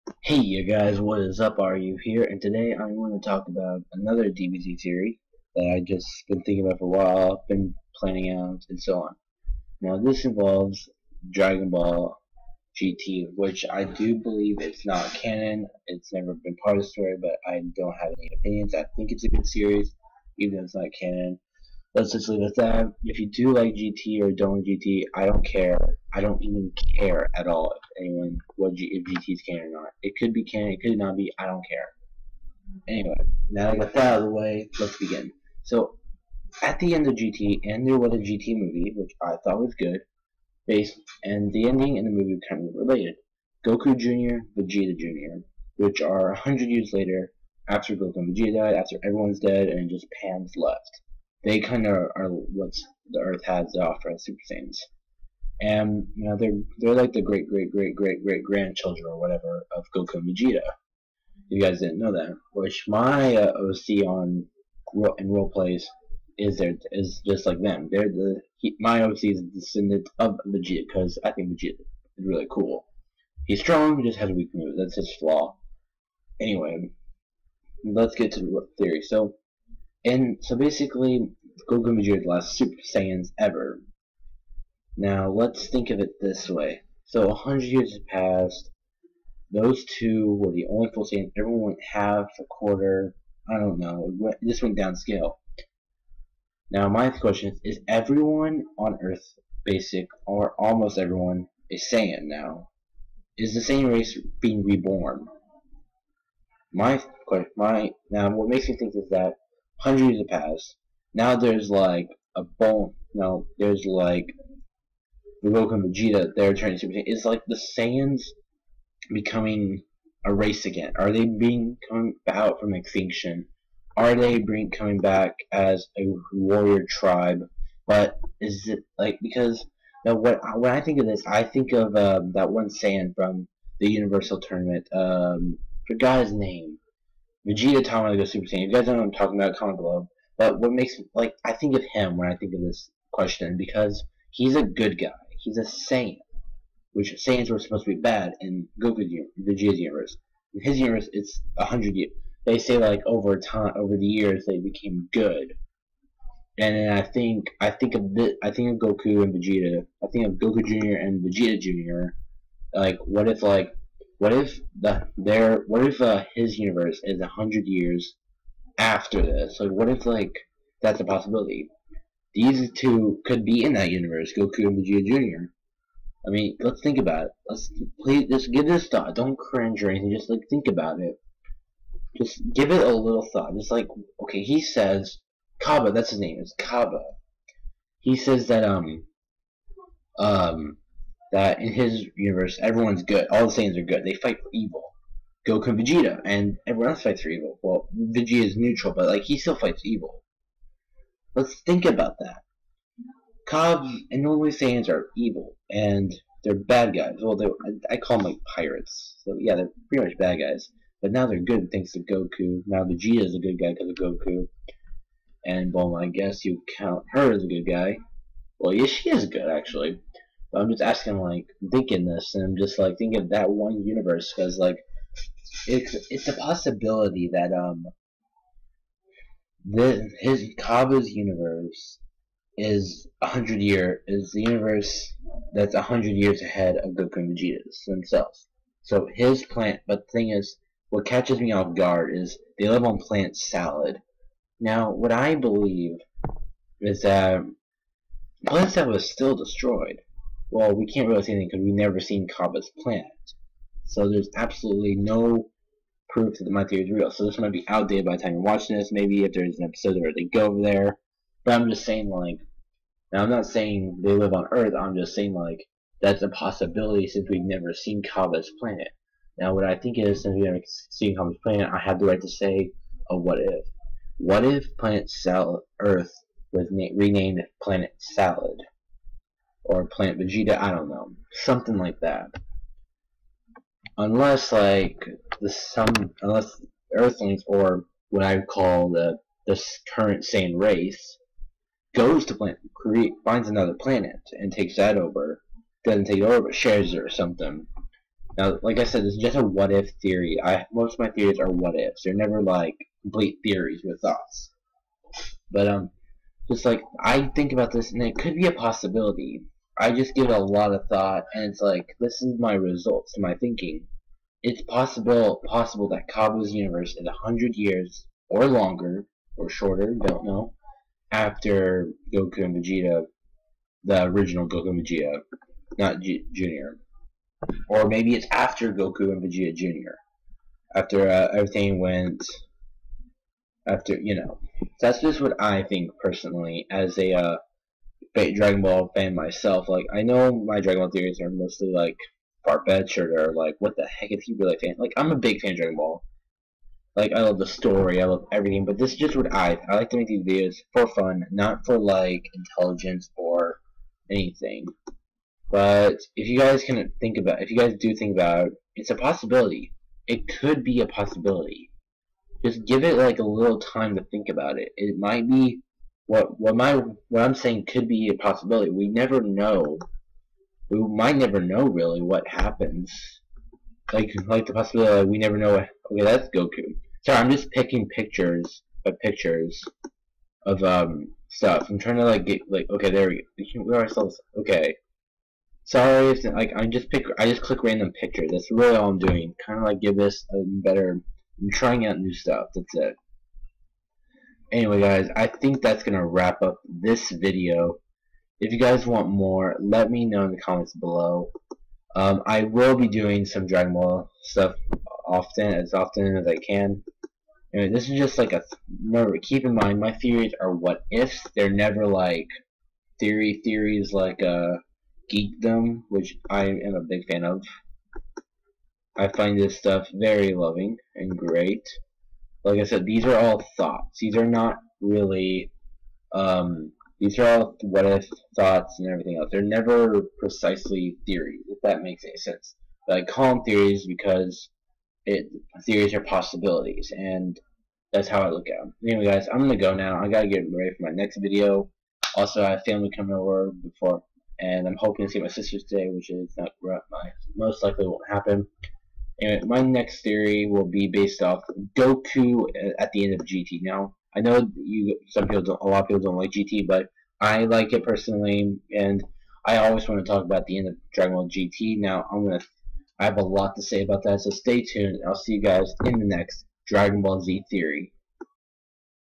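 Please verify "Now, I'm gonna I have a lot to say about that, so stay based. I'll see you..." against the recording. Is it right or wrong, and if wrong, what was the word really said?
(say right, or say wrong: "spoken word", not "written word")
wrong: "tuned", not "based".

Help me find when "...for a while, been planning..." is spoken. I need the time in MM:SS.
00:06.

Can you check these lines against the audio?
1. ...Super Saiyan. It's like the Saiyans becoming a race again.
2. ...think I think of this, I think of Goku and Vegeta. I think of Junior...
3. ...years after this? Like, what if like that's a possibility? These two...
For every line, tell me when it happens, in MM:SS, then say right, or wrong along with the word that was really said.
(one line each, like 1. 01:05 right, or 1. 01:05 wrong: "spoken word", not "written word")
1. 01:56 right
2. 02:37 wrong: "Goku", not "Junior"
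3. 02:47 right.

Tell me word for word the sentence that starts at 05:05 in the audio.
But um, just like I think about this, and it could be a possibility.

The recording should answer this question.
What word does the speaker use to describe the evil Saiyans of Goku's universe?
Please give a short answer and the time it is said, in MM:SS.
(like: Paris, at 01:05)
pirates, at 03:28.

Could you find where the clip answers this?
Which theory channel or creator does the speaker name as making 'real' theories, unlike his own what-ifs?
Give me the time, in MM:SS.
06:55.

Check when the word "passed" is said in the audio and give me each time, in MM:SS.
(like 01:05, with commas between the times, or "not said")
01:28, 01:50.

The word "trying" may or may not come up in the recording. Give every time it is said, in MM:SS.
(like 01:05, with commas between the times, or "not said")
06:21, 06:31.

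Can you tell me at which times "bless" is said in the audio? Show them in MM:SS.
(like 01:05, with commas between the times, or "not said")
not said.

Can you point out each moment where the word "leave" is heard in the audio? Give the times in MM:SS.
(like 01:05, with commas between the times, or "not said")
00:22.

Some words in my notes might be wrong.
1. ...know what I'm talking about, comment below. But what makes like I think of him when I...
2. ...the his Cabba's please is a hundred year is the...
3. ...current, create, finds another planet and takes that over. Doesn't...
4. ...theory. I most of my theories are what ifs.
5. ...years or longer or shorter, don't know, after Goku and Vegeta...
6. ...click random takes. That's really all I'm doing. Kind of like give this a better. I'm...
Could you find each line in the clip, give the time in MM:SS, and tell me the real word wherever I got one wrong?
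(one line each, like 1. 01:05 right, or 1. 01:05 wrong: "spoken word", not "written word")
1. 02:18 right
2. 03:49 wrong: "universe", not "please"
3. 04:52 wrong: "plant", not "current"
4. 05:00 right
5. 05:17 right
6. 06:27 wrong: "pictures", not "takes".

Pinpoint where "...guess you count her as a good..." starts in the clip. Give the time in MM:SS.
03:36.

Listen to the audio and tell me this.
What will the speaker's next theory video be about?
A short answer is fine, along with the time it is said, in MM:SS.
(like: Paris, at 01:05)
Goku at the end of GT, at 07:31.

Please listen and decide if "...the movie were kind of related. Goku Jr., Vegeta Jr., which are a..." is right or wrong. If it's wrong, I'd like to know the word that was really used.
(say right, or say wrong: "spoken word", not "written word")
right.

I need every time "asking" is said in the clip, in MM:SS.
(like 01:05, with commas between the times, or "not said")
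03:40.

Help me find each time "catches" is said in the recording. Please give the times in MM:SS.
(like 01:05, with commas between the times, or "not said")
04:01.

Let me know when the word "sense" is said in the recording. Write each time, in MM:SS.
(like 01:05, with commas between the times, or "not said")
07:12.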